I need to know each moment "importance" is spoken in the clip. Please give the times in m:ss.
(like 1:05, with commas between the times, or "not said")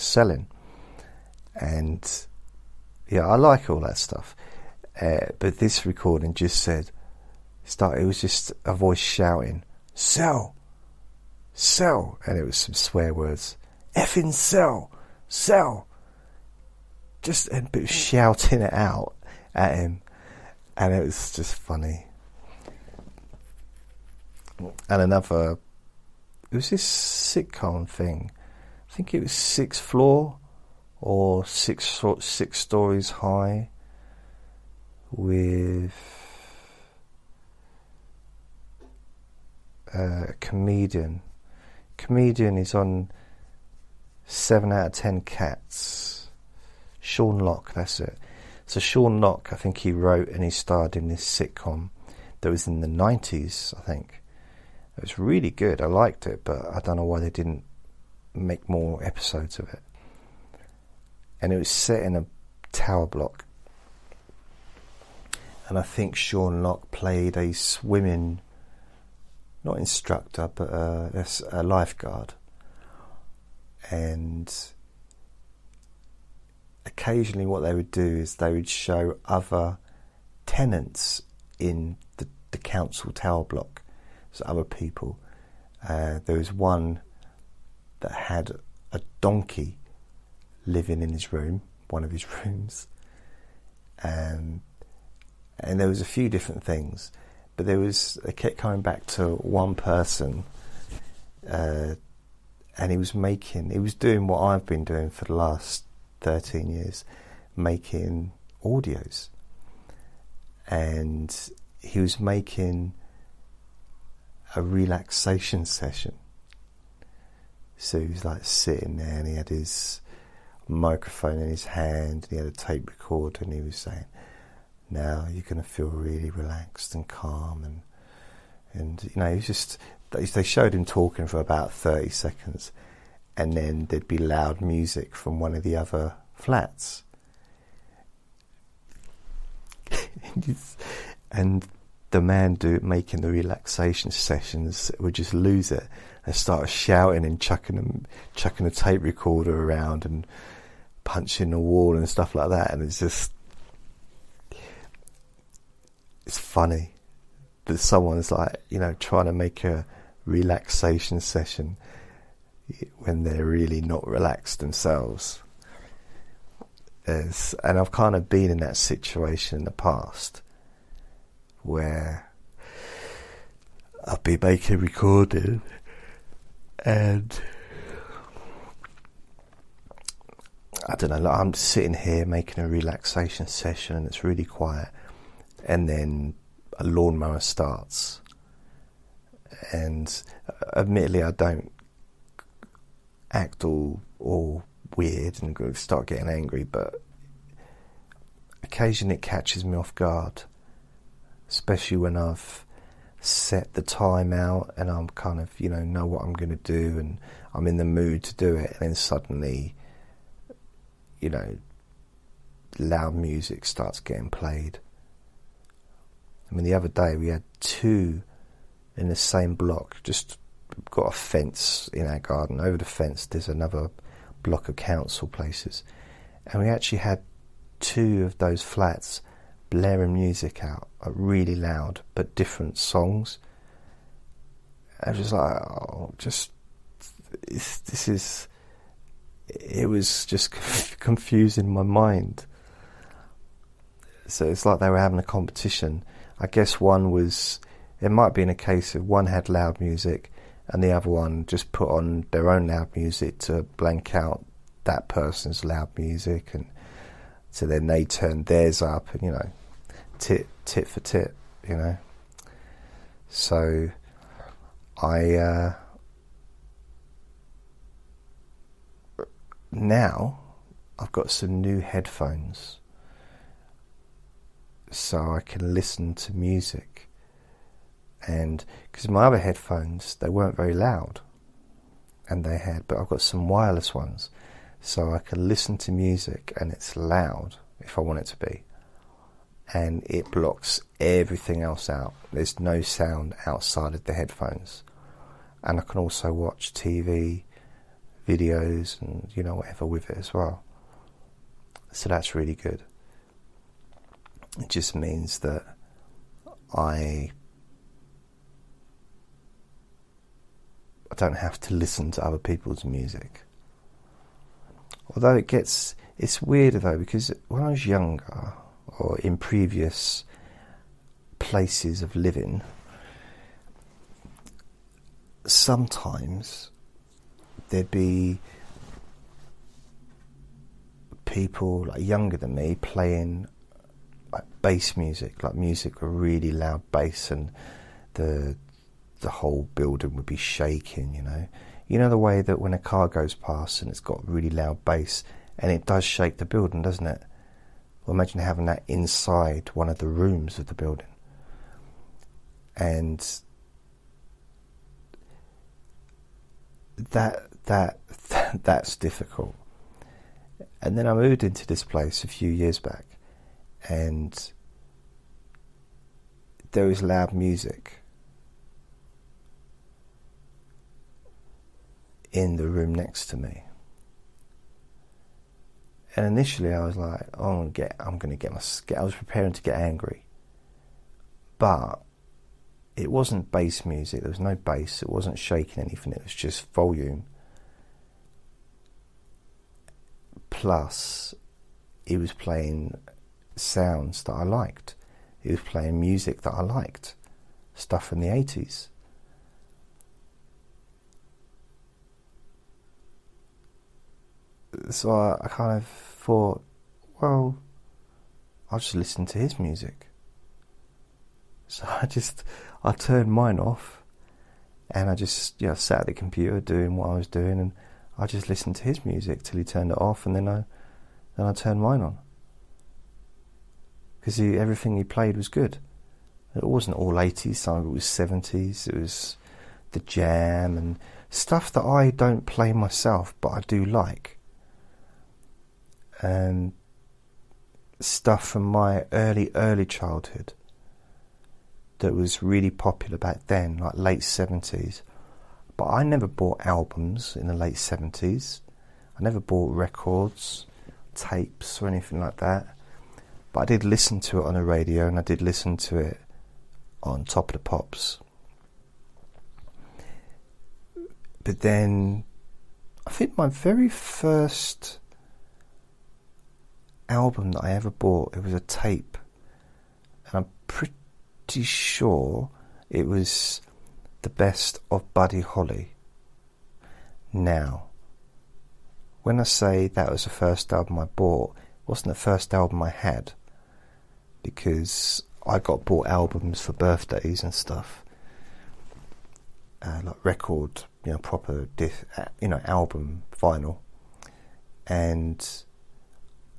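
not said.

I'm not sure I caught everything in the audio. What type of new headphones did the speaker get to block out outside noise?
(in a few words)
Wireless.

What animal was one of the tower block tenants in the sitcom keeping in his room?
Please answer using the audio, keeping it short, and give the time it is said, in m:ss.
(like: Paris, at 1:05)
Donkey, at 1:29.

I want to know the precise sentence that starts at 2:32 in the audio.
And it's just, it's funny that someone's like, you know, trying to make a relaxation session when they're really not relaxed themselves.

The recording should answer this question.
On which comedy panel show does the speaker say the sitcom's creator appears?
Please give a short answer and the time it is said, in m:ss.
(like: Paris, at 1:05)
8 Out of 10 Cats, at 0:44.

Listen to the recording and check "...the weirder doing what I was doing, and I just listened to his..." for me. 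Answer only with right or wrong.
wrong.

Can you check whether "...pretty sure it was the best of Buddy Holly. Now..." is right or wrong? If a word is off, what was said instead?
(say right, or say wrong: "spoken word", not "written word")
right.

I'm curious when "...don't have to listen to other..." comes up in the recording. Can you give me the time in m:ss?
5:11.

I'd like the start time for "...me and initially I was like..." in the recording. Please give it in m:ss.
6:13.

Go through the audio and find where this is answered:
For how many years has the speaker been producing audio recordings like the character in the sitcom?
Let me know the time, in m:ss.
1:46.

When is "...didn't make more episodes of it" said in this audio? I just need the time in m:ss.
0:57.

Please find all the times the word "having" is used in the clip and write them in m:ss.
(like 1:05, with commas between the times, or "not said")
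4:04, 5:48.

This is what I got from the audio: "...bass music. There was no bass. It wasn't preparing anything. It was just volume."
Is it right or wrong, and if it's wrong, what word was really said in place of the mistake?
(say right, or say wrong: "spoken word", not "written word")
wrong: "shaking", not "preparing".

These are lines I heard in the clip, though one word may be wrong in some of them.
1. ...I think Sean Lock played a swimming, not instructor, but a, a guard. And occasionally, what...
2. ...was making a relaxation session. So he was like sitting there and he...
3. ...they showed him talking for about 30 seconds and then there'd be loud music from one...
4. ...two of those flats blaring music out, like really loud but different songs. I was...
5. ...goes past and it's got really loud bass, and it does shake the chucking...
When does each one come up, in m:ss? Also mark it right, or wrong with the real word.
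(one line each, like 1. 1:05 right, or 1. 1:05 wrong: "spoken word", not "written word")
1. 1:05 wrong: "lifeguard", not "guard"
2. 1:52 right
3. 2:10 right
4. 3:47 right
5. 5:43 wrong: "building", not "chucking".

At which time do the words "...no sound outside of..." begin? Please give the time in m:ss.
4:52.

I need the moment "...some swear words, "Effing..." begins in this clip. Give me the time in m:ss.
0:12.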